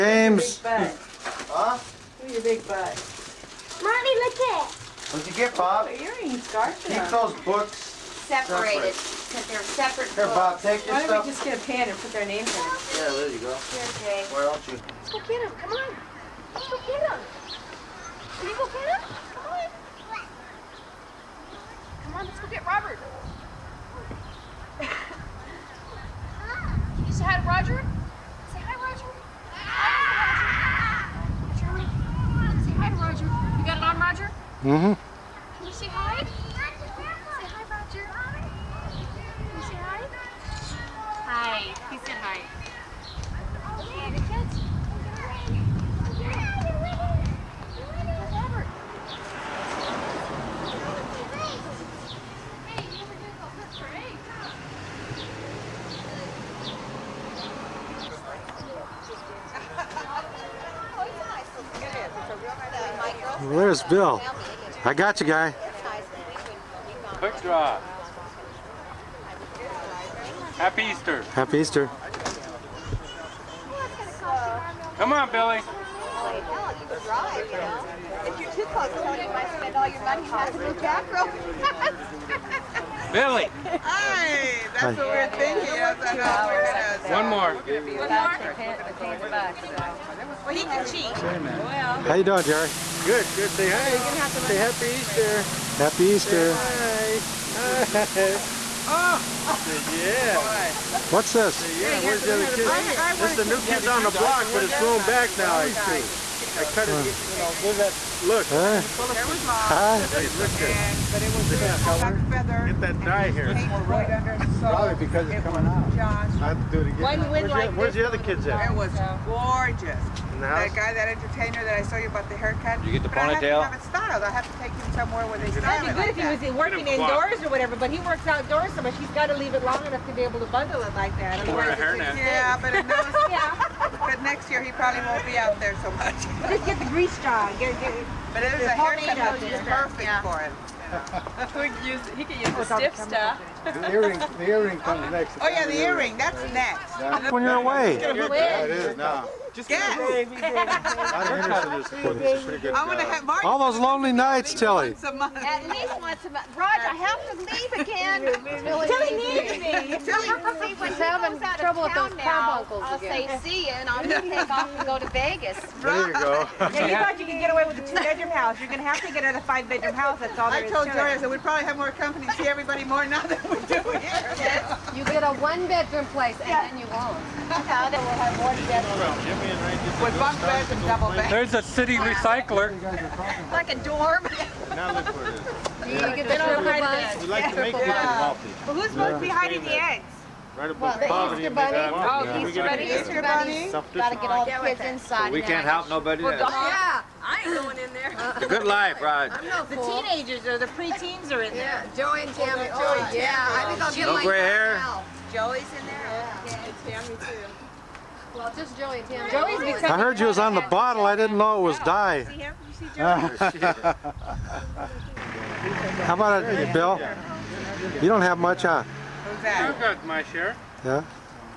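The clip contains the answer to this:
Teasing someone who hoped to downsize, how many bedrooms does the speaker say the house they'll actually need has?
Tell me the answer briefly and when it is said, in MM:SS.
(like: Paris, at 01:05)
5, at 02:49.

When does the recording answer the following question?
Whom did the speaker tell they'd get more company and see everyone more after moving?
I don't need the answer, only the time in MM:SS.
02:50.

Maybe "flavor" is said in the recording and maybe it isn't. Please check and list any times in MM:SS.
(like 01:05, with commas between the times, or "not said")
not said.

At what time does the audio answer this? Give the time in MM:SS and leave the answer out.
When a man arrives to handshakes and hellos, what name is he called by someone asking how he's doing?
01:32.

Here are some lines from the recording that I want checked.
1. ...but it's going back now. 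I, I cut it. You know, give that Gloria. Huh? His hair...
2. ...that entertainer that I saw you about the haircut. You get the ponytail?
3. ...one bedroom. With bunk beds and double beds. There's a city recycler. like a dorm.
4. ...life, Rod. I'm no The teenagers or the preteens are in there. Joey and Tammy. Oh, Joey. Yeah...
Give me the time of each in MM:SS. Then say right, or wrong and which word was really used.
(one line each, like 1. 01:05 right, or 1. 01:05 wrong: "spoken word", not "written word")
1. 01:44 wrong: "Look", not "Gloria"
2. 02:00 right
3. 02:58 right
4. 03:18 right.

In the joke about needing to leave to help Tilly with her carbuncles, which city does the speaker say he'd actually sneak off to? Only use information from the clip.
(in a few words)
Vegas.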